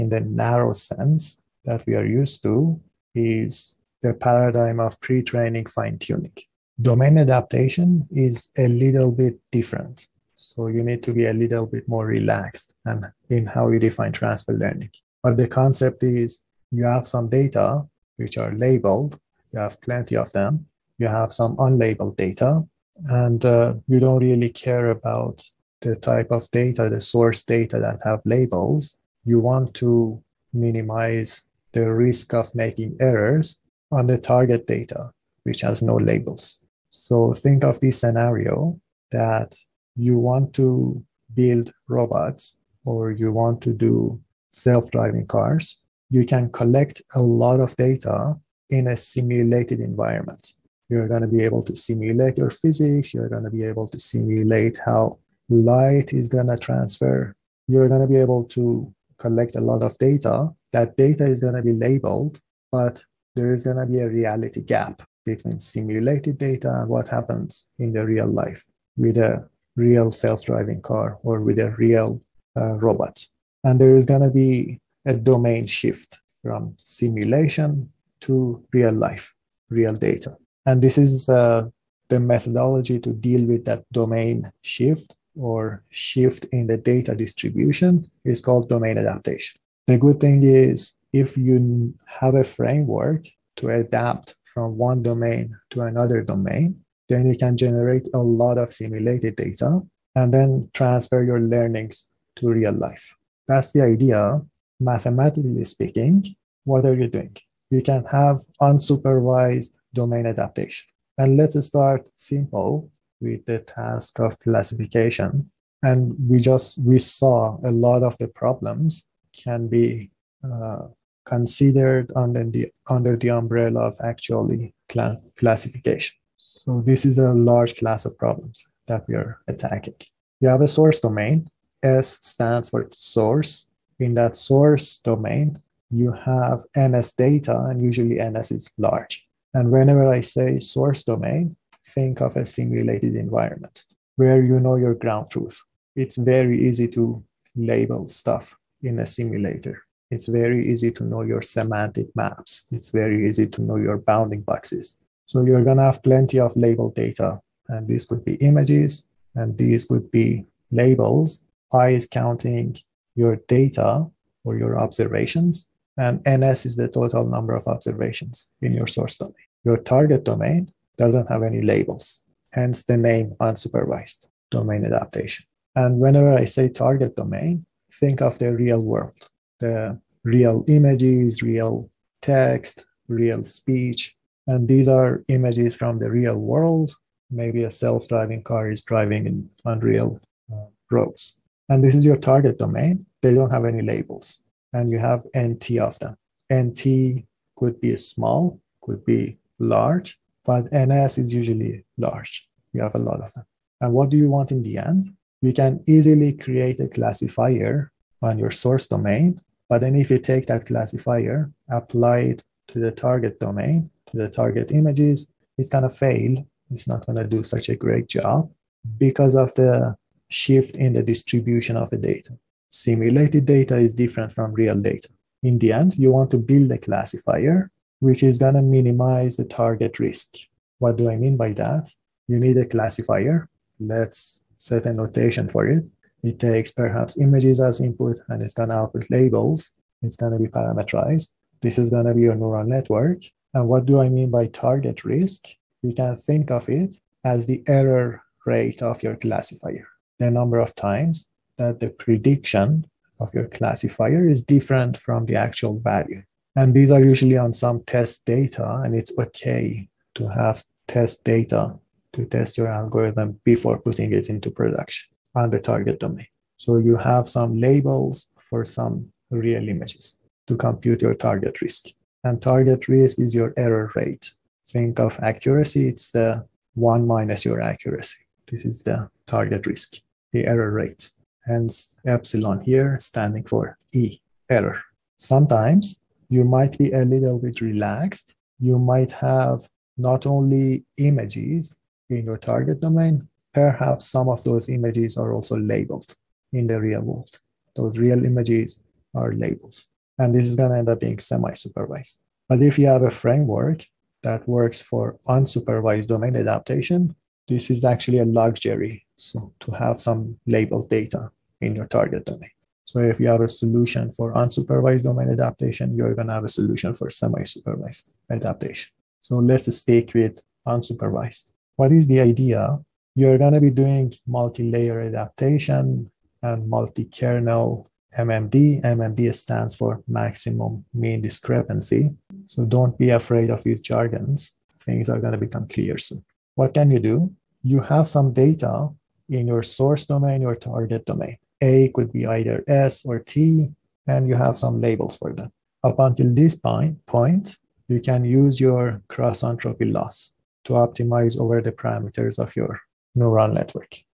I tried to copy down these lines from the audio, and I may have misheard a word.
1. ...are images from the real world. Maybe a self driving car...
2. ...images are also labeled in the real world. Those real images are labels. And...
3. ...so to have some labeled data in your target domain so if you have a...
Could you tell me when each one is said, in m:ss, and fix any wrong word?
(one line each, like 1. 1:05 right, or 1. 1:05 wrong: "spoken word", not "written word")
1. 3:04 right
2. 4:54 right
3. 5:09 right.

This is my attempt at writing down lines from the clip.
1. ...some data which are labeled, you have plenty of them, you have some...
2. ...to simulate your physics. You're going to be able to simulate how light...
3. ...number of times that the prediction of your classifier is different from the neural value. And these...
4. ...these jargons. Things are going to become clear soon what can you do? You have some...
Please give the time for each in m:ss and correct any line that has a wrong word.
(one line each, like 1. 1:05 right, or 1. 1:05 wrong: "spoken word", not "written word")
1. 0:17 right
2. 0:51 right
3. 4:10 wrong: "actual", not "neural"
4. 5:33 right.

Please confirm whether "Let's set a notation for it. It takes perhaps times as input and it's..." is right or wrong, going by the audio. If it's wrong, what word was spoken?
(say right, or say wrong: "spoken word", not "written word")
wrong: "images", not "times".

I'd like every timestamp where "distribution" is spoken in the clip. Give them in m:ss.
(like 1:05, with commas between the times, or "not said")
1:27, 3:41.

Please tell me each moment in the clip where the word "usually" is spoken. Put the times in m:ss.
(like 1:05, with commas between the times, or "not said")
2:17, 3:21, 4:17.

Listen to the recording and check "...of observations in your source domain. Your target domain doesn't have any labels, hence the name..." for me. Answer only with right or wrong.
right.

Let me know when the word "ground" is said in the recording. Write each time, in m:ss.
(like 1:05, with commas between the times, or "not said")
2:24.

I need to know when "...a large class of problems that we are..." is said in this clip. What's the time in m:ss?
2:07.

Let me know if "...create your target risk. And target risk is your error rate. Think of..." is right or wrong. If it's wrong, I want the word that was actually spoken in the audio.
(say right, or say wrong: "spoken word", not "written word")
wrong: "compute", not "create".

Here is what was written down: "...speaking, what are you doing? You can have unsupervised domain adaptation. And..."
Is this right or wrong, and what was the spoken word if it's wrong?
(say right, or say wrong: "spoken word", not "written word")
right.